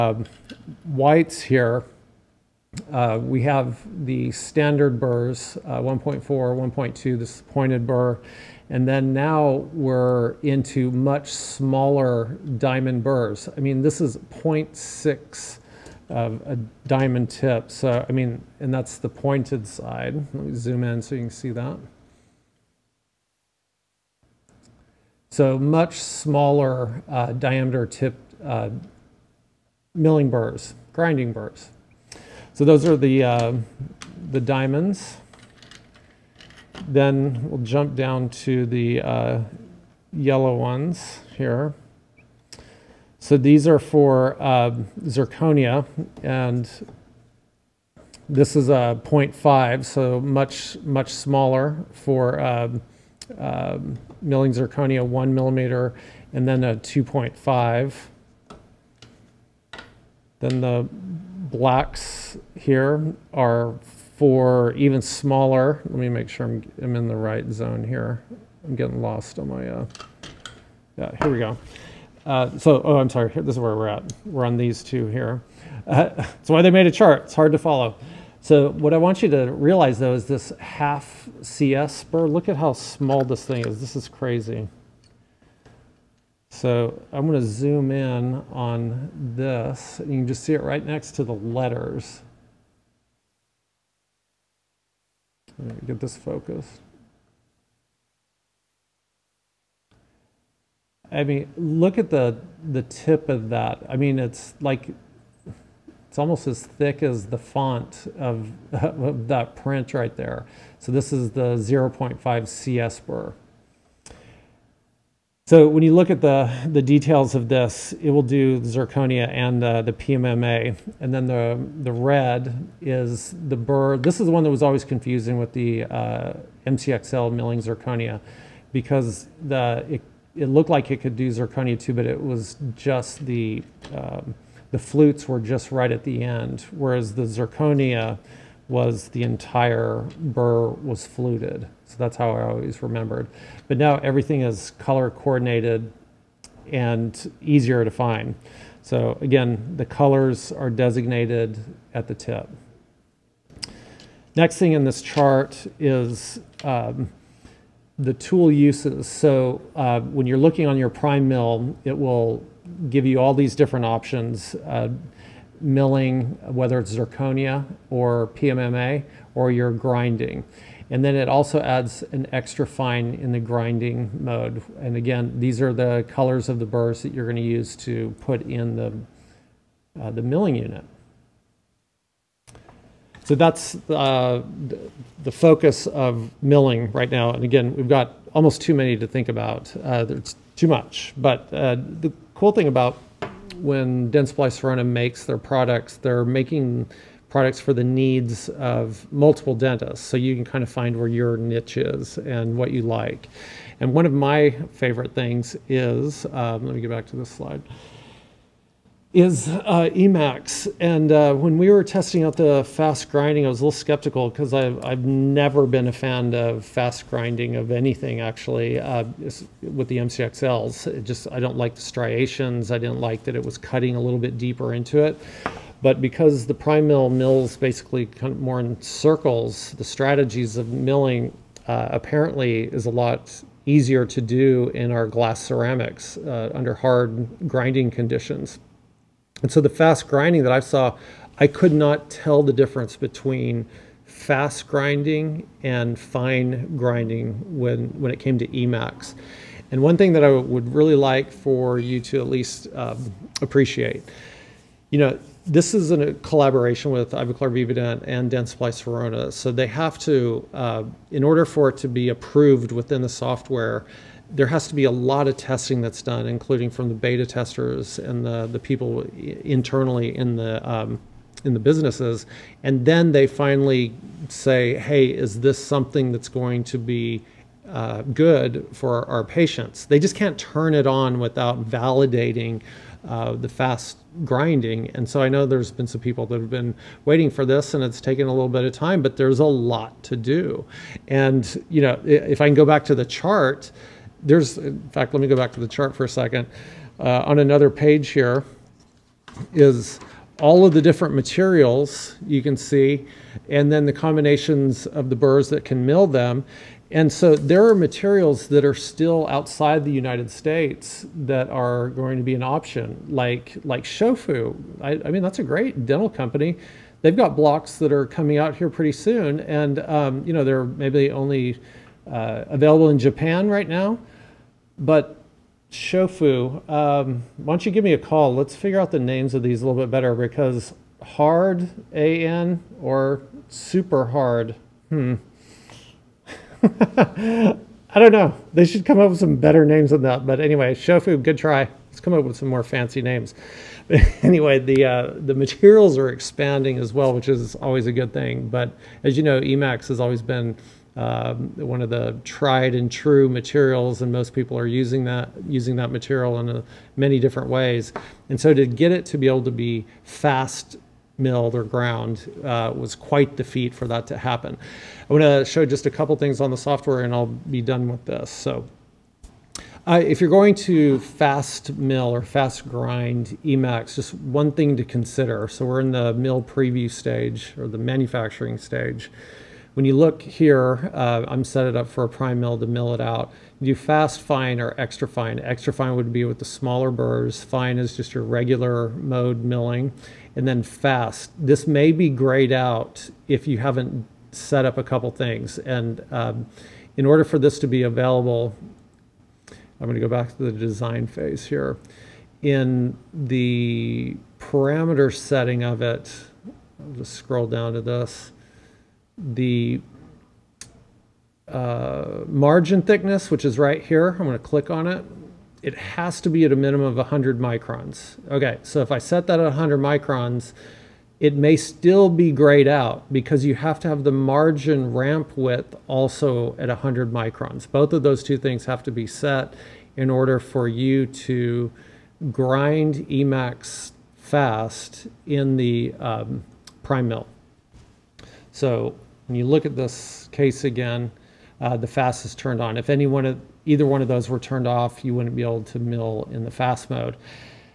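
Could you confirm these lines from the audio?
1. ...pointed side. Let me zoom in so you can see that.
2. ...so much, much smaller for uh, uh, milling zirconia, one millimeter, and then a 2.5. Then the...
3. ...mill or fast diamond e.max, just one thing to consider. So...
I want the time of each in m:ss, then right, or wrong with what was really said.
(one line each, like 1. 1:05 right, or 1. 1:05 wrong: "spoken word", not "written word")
1. 0:19 right
2. 0:49 right
3. 6:11 wrong: "grind", not "diamond".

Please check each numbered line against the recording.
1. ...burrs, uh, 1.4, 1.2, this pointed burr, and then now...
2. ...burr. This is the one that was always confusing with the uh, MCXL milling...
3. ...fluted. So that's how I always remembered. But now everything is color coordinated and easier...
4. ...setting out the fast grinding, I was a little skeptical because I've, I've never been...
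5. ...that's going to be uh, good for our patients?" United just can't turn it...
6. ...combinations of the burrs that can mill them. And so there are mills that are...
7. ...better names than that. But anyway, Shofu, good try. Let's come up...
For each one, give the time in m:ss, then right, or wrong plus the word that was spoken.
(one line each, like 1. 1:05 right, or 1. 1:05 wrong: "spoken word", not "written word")
1. 0:04 right
2. 2:03 right
3. 2:21 right
4. 3:31 wrong: "testing", not "setting"
5. 4:36 wrong: "They", not "United"
6. 5:03 wrong: "materials", not "mills"
7. 5:39 right.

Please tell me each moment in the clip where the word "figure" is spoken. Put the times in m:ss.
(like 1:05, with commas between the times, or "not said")
5:28.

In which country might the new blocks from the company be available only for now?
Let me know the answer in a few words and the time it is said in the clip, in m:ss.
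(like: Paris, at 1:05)
Japan, at 5:22.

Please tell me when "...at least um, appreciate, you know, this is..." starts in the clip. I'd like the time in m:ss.
4:12.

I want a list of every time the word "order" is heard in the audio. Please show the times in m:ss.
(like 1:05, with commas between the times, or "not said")
4:21, 6:37, 7:10.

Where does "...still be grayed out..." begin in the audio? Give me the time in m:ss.
7:01.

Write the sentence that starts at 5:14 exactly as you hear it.
I, I mean, that's a great dental company.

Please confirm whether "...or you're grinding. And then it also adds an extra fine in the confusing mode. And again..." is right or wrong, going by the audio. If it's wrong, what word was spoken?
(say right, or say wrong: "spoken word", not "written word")
wrong: "grinding", not "confusing".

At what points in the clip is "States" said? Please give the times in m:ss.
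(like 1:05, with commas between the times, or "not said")
5:10.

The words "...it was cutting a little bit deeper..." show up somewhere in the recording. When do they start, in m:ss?
3:43.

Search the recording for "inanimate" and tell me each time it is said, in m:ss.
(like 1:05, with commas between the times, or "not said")
not said.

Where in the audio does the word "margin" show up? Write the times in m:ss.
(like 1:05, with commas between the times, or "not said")
6:52, 7:04.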